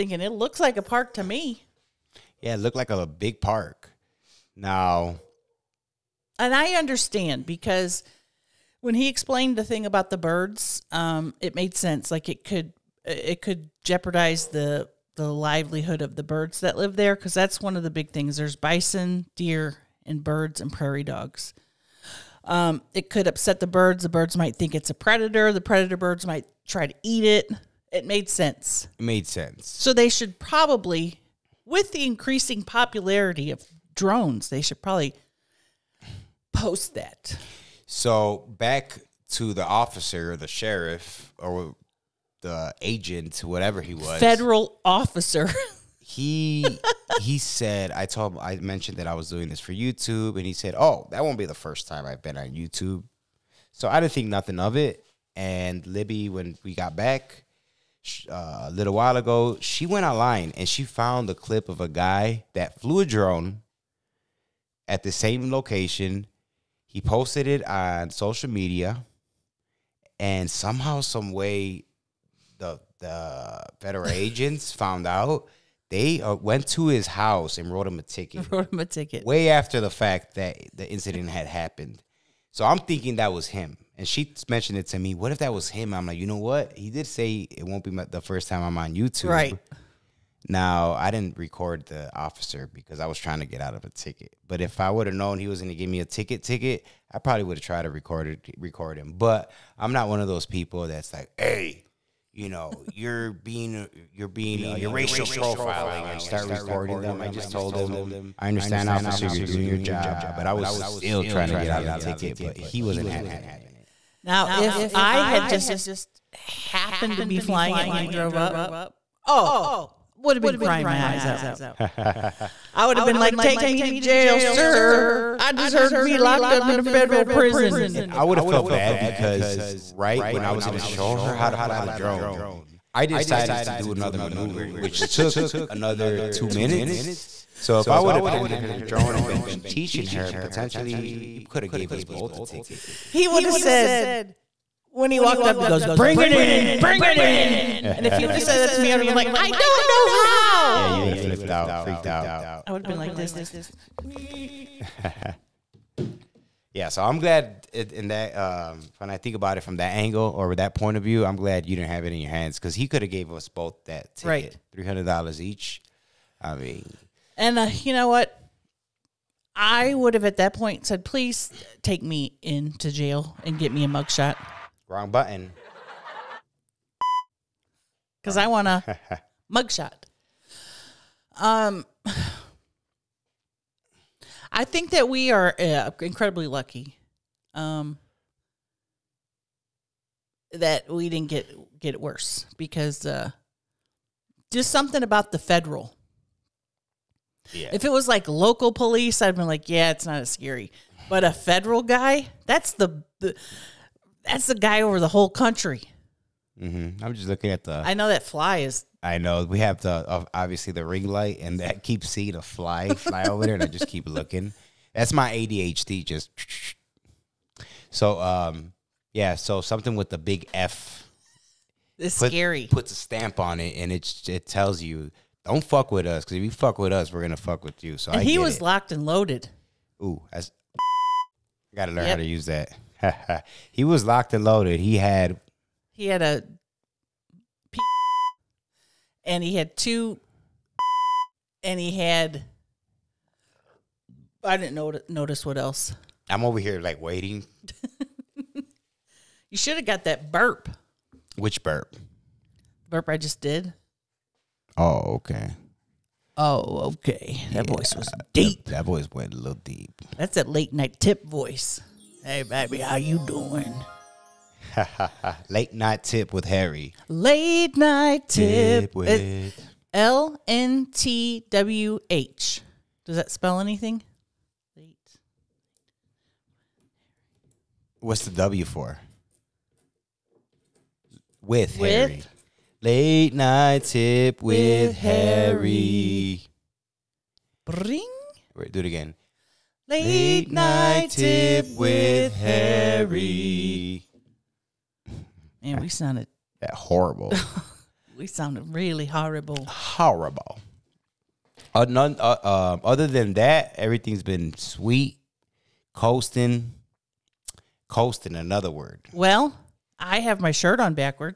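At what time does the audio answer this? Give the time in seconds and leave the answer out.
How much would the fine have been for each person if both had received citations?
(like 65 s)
164 s.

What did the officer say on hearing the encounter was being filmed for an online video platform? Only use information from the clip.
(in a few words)
That won't be the first time I've been on YouTube.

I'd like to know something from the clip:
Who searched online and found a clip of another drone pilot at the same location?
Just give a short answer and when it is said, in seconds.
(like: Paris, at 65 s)
Libbie, at 55 s.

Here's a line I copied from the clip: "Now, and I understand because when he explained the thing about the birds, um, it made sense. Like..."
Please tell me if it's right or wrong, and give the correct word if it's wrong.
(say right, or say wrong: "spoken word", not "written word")
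right.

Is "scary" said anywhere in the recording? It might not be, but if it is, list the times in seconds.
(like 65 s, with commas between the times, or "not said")
200 s, 222 s.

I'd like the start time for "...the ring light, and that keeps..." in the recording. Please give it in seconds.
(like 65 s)
210 s.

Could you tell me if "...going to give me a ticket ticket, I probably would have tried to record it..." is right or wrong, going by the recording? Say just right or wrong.
right.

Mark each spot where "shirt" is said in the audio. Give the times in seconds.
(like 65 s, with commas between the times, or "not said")
310 s.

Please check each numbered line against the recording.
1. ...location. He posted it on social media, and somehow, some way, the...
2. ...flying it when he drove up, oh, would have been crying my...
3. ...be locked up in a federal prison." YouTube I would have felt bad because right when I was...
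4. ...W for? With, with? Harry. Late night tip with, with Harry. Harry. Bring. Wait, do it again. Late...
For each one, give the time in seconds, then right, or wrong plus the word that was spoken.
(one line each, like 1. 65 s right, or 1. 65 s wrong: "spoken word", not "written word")
1. 65 s right
2. 117 s right
3. 125 s wrong: "And", not "YouTube"
4. 278 s right.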